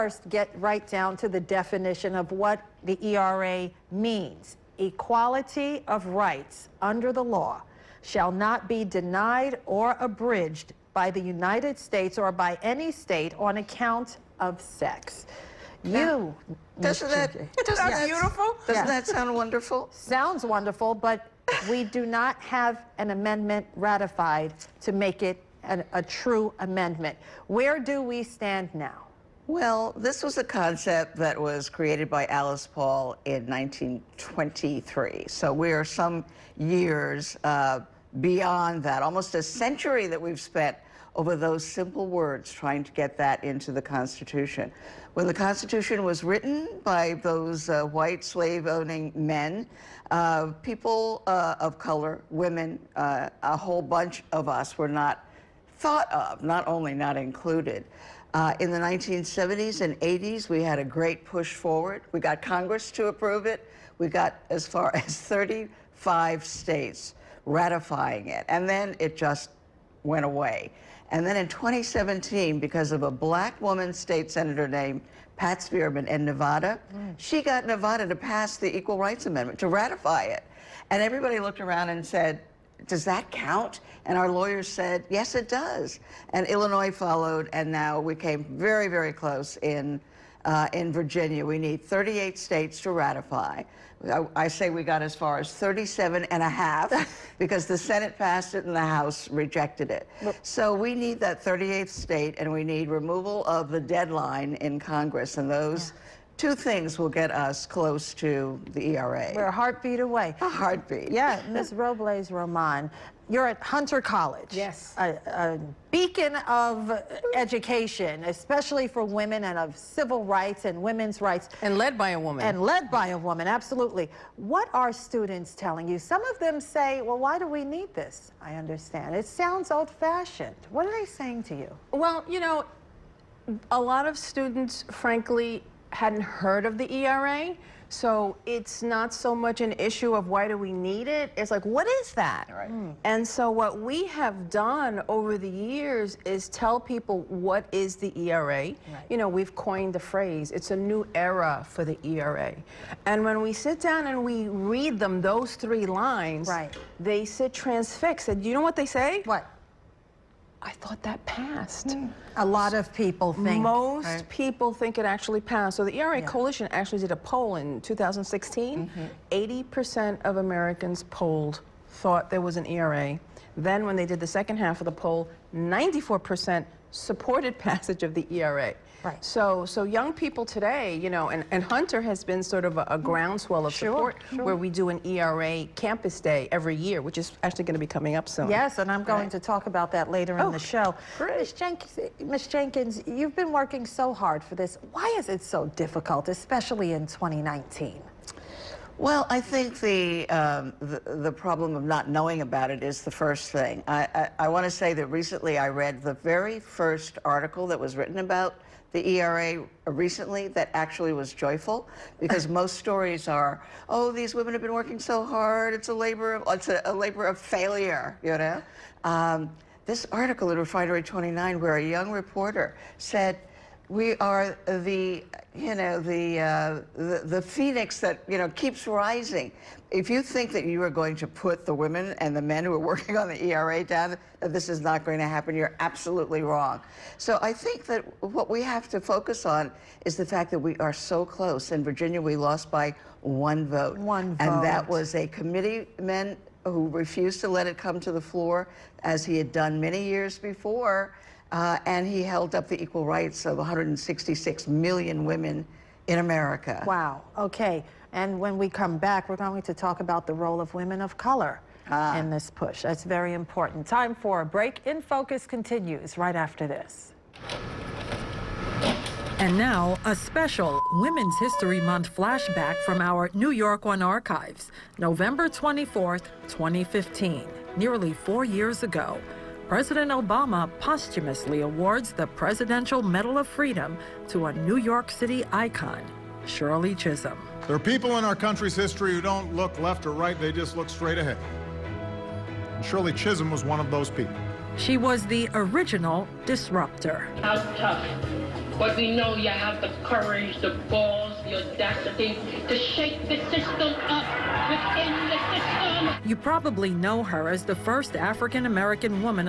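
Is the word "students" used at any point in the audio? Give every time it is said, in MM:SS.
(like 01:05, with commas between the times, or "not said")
02:04, 02:14.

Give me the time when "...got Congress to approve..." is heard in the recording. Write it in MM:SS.
01:02.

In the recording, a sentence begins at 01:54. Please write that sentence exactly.
A, a, beacon of education, especially for women and of civil rights and women's rights.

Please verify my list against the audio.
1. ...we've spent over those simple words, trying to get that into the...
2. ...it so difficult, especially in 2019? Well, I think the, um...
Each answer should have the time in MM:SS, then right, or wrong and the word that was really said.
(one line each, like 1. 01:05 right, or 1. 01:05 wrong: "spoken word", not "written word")
1. 00:40 right
2. 03:15 right.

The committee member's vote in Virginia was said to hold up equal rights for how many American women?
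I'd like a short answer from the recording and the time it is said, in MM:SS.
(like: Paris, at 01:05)
166 million, at 04:13.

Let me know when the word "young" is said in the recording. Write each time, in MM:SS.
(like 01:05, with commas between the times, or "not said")
02:59, 03:41.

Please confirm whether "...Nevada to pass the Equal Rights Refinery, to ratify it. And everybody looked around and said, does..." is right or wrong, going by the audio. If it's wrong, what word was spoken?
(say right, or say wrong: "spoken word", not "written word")
wrong: "Amendment", not "Refinery".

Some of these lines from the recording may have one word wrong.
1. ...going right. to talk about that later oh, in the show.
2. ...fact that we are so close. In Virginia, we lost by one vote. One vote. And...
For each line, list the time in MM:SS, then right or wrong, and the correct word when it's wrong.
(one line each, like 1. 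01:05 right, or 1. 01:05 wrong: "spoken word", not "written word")
1. 03:09 right
2. 04:00 right.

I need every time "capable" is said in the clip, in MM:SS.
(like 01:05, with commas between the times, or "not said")
not said.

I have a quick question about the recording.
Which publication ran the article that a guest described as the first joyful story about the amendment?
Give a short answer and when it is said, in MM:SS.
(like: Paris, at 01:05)
Refinery 29, at 03:40.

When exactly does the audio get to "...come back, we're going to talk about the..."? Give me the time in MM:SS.
04:18.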